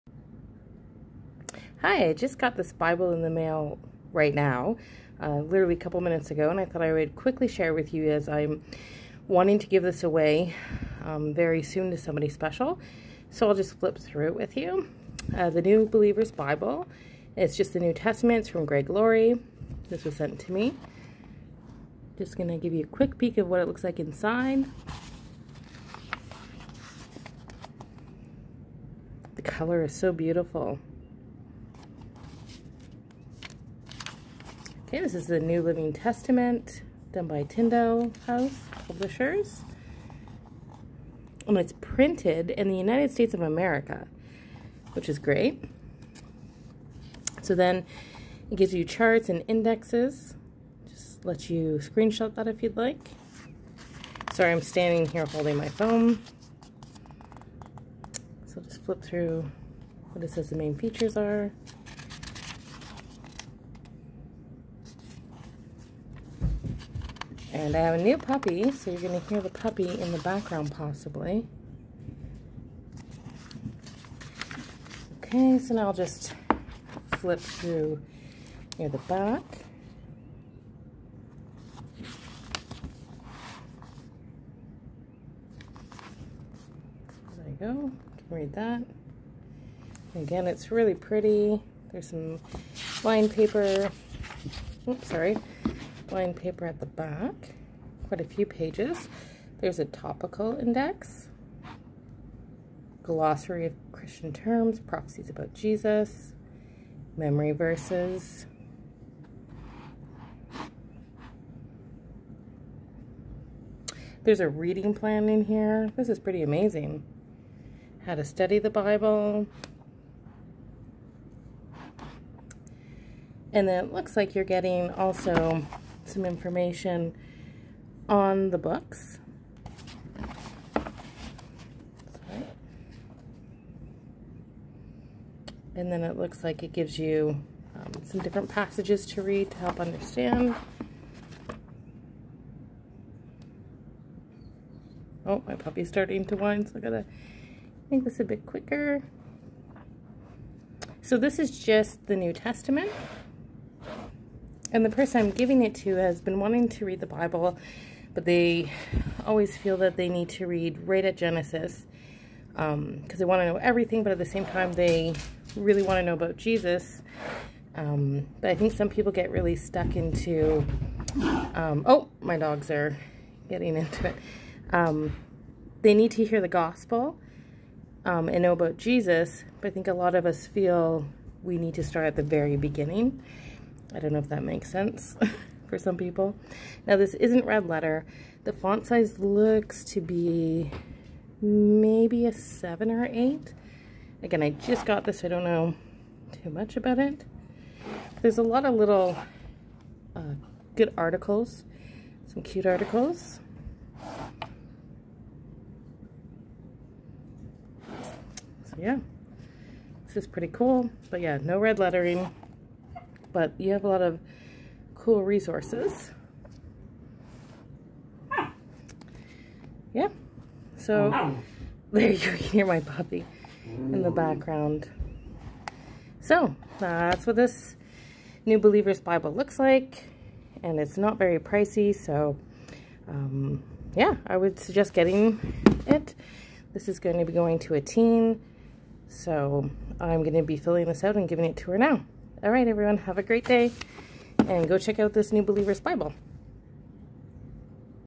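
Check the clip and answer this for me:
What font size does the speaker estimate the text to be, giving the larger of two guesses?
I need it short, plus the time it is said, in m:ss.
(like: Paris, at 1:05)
8, at 3:13.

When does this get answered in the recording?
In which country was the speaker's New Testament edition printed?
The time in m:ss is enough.
0:42.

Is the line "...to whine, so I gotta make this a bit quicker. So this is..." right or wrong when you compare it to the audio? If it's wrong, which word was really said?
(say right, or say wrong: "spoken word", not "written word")
right.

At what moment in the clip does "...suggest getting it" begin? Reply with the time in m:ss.
3:54.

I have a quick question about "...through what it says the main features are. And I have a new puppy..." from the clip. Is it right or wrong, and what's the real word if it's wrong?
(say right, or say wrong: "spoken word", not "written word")
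right.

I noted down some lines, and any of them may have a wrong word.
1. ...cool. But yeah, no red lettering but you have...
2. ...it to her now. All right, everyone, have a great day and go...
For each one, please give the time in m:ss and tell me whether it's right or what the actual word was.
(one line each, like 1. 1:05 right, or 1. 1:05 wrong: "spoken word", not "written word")
1. 3:30 right
2. 4:01 right.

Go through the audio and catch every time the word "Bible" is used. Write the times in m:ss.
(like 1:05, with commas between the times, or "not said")
0:02, 0:16, 1:58, 2:37, 3:49, 4:05.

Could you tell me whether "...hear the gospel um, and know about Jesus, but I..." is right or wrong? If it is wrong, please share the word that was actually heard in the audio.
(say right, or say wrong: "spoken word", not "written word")
right.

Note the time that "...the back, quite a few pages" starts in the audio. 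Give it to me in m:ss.
1:36.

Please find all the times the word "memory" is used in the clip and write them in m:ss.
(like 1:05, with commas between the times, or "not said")
1:47.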